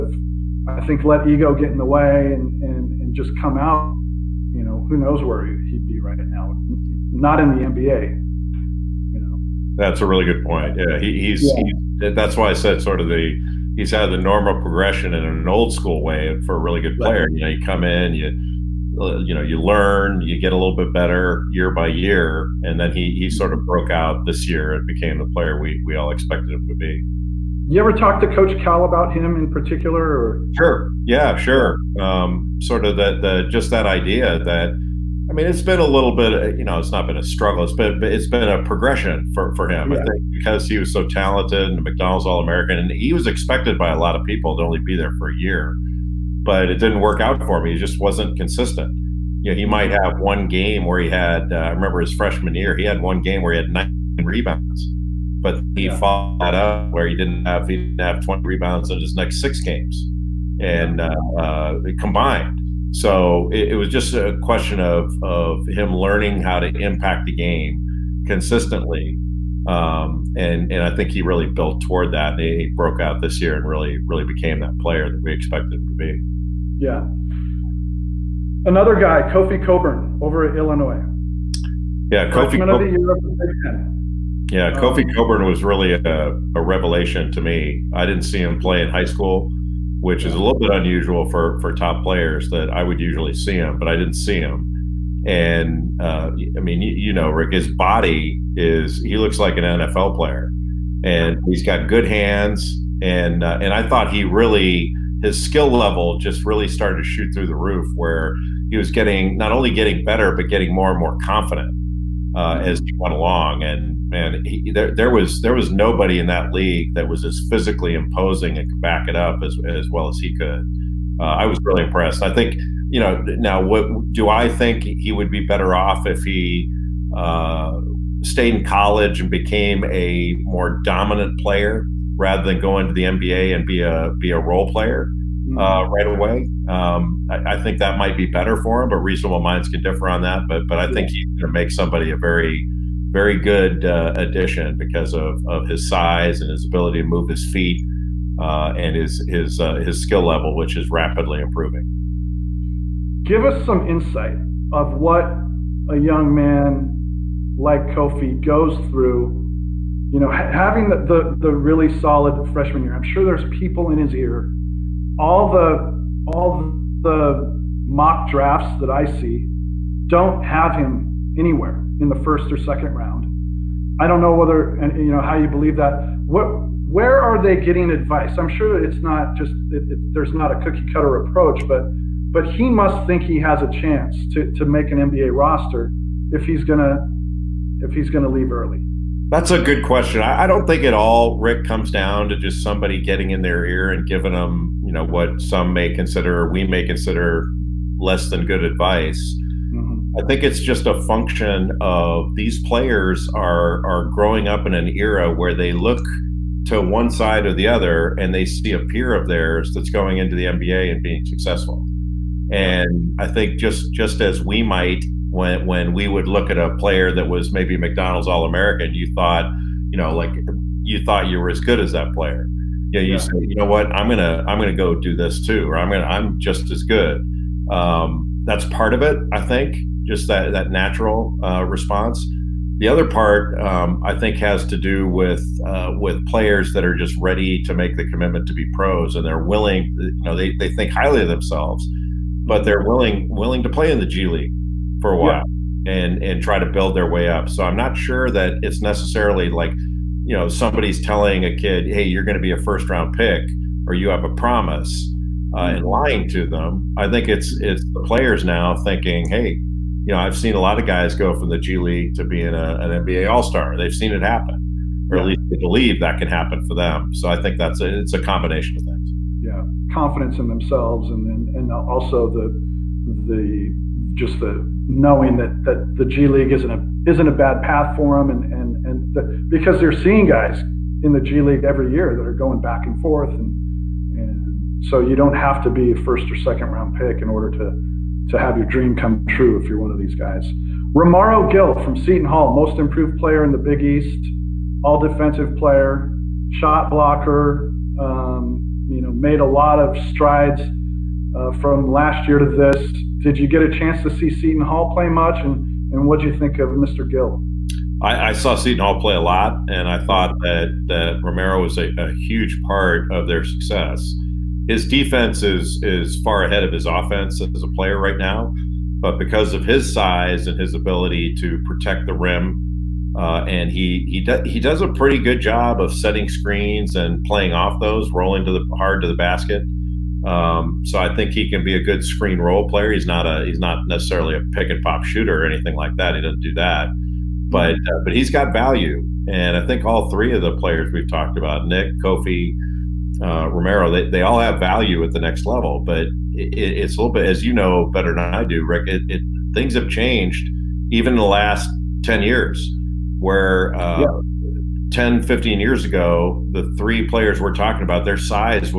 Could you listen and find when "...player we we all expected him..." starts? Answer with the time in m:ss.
0:25.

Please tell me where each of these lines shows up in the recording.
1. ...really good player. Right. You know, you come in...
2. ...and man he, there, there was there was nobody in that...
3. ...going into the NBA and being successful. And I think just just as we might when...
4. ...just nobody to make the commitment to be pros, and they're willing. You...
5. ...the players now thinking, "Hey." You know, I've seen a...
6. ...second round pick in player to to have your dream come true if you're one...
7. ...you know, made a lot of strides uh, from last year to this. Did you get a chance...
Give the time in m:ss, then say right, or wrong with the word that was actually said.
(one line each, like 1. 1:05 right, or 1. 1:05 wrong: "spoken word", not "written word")
1. 0:16 right
2. 1:53 right
3. 3:29 right
4. 3:56 wrong: "ready", not "nobody"
5. 4:17 right
6. 4:46 wrong: "order", not "player"
7. 4:58 right.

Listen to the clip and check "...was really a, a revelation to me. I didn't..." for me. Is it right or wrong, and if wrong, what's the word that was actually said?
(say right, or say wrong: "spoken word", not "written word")
right.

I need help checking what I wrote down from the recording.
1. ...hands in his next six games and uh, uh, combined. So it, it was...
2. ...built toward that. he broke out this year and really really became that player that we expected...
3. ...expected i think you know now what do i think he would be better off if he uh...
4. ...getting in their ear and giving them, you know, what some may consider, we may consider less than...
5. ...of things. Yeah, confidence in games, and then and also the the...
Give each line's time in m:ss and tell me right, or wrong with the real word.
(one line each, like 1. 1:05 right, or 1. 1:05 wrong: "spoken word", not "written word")
1. 0:58 wrong: "rebounds", not "hands"
2. 1:11 right
3. 2:01 wrong: "impressed", not "expected"
4. 3:12 right
5. 4:28 wrong: "themselves", not "games".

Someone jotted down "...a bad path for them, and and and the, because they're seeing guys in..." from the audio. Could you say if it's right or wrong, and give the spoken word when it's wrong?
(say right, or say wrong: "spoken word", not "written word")
right.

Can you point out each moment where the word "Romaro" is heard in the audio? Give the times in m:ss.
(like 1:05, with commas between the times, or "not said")
4:50, 5:11, 5:43.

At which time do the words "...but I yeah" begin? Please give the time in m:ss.
2:20.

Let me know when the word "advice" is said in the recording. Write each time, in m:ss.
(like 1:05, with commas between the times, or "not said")
2:57, 3:18.